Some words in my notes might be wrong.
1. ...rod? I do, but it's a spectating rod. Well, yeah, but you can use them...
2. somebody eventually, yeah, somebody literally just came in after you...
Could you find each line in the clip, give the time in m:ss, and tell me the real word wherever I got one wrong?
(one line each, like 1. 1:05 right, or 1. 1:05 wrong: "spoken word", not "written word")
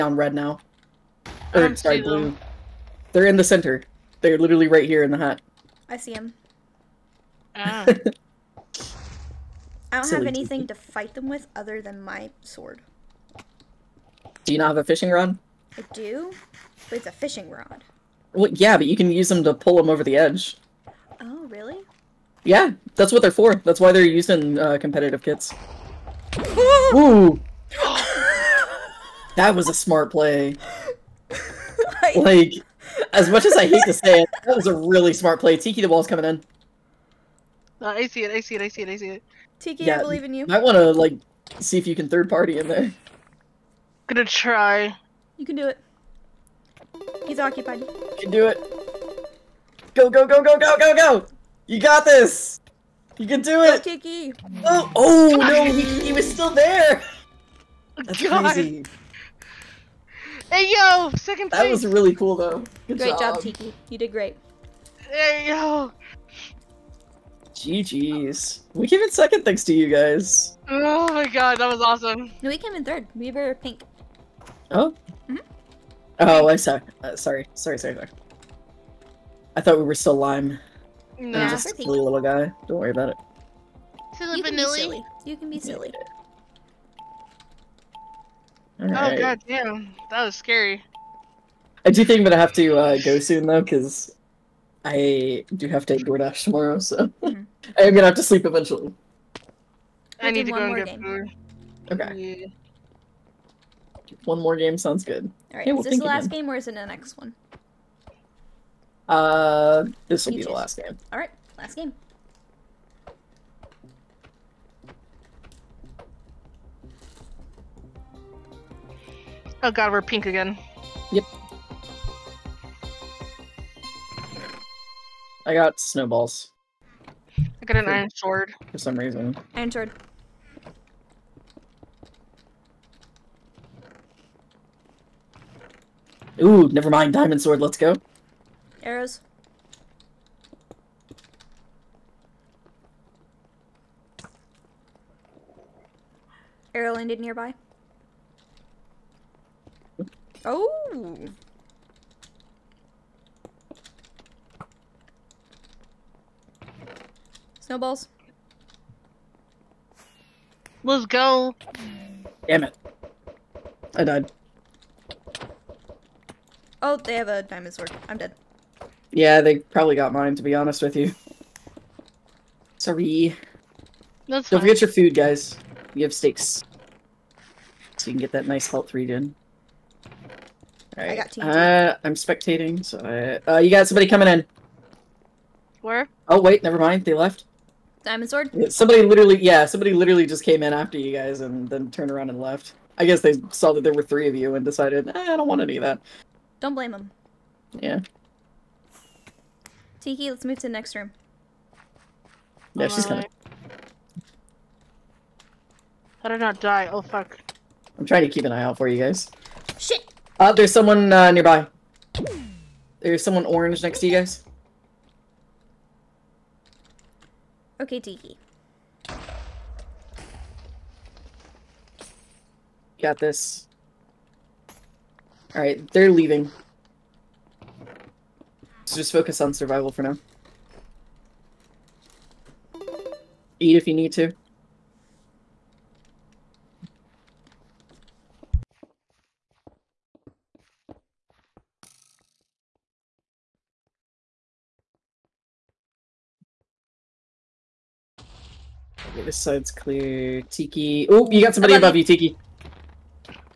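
1. 0:15 wrong: "fishing", not "spectating"
2. 3:08 wrong: "literally", not "eventually".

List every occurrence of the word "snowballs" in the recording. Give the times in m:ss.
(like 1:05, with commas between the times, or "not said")
2:05, 2:37.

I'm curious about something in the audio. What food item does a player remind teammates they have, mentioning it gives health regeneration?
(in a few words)
Steaks.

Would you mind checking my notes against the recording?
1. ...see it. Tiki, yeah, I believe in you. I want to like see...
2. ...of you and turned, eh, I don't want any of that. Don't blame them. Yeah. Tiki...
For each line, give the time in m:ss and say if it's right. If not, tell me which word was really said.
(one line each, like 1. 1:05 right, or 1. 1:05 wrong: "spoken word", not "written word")
1. 0:38 right
2. 3:14 wrong: "decided", not "turned".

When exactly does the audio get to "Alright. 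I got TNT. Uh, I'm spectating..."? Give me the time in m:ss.
3:00.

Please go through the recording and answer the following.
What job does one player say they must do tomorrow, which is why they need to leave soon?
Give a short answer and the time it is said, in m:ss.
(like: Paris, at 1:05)
DoorDash, at 1:35.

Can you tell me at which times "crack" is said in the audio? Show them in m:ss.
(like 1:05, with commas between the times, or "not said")
not said.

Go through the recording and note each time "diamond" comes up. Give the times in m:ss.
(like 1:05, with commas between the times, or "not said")
2:17, 2:47, 3:08.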